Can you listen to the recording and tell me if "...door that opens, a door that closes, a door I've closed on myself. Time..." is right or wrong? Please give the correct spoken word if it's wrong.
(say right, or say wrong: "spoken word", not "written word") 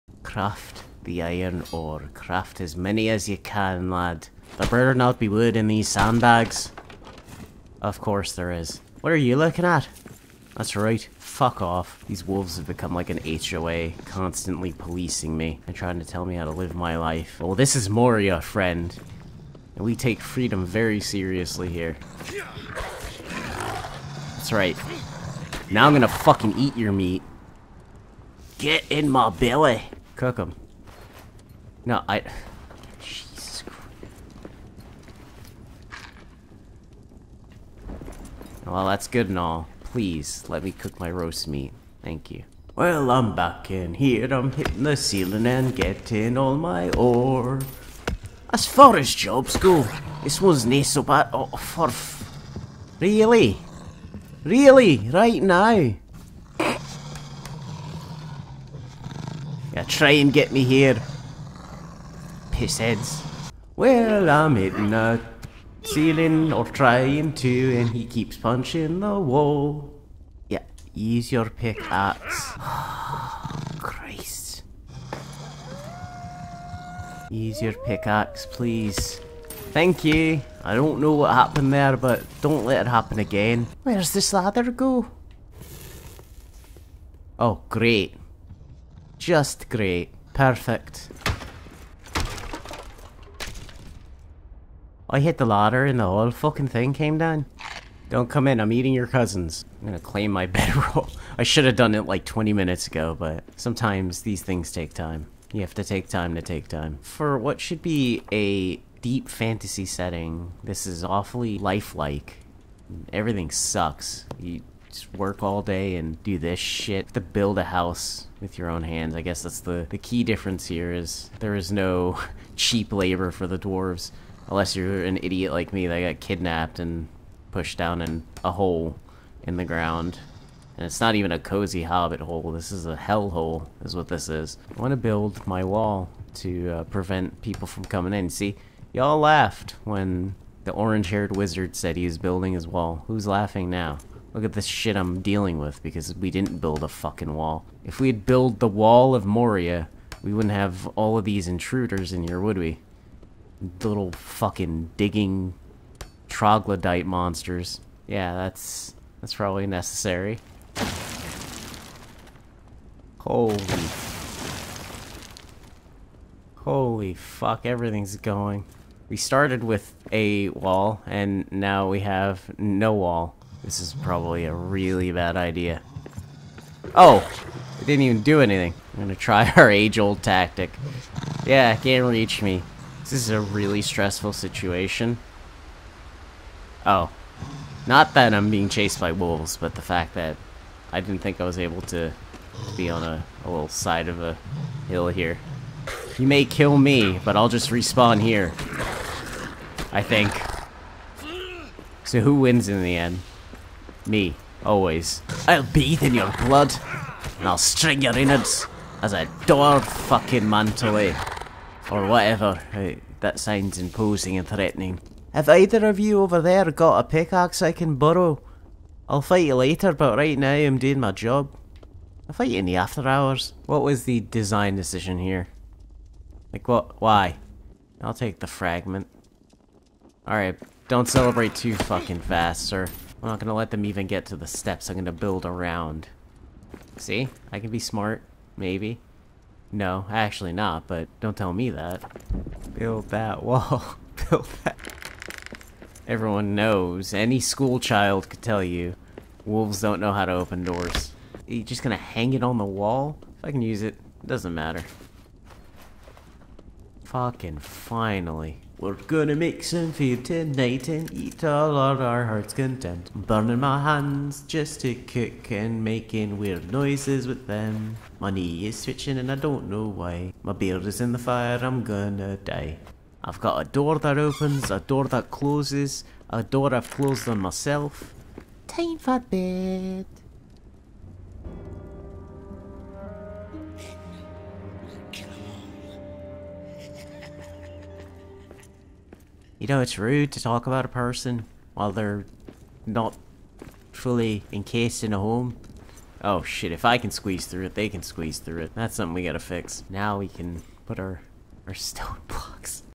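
right.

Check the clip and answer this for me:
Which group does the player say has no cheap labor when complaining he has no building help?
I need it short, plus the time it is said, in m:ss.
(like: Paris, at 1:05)
the dwarves, at 2:03.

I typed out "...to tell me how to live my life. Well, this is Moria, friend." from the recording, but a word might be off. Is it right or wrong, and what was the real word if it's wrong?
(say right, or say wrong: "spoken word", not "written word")
right.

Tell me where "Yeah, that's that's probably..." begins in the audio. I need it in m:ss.
2:38.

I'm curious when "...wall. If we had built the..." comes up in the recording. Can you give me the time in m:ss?
2:27.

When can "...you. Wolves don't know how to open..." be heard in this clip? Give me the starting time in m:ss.
4:08.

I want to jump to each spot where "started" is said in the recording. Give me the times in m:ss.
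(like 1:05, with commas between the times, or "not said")
2:49.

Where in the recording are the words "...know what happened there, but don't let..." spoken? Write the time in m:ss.
1:20.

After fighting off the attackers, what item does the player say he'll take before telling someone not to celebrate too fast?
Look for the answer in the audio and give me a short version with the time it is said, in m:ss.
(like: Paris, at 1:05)
the fragment, at 3:48.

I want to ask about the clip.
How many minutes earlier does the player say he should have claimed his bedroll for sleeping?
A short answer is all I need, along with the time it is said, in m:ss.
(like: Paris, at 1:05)
20, at 1:42.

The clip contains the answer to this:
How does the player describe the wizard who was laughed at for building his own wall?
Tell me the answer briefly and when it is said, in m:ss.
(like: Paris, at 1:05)
orange-haired wizard, at 2:20.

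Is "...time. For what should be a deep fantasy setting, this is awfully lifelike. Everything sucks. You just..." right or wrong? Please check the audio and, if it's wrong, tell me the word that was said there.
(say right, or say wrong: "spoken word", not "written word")
right.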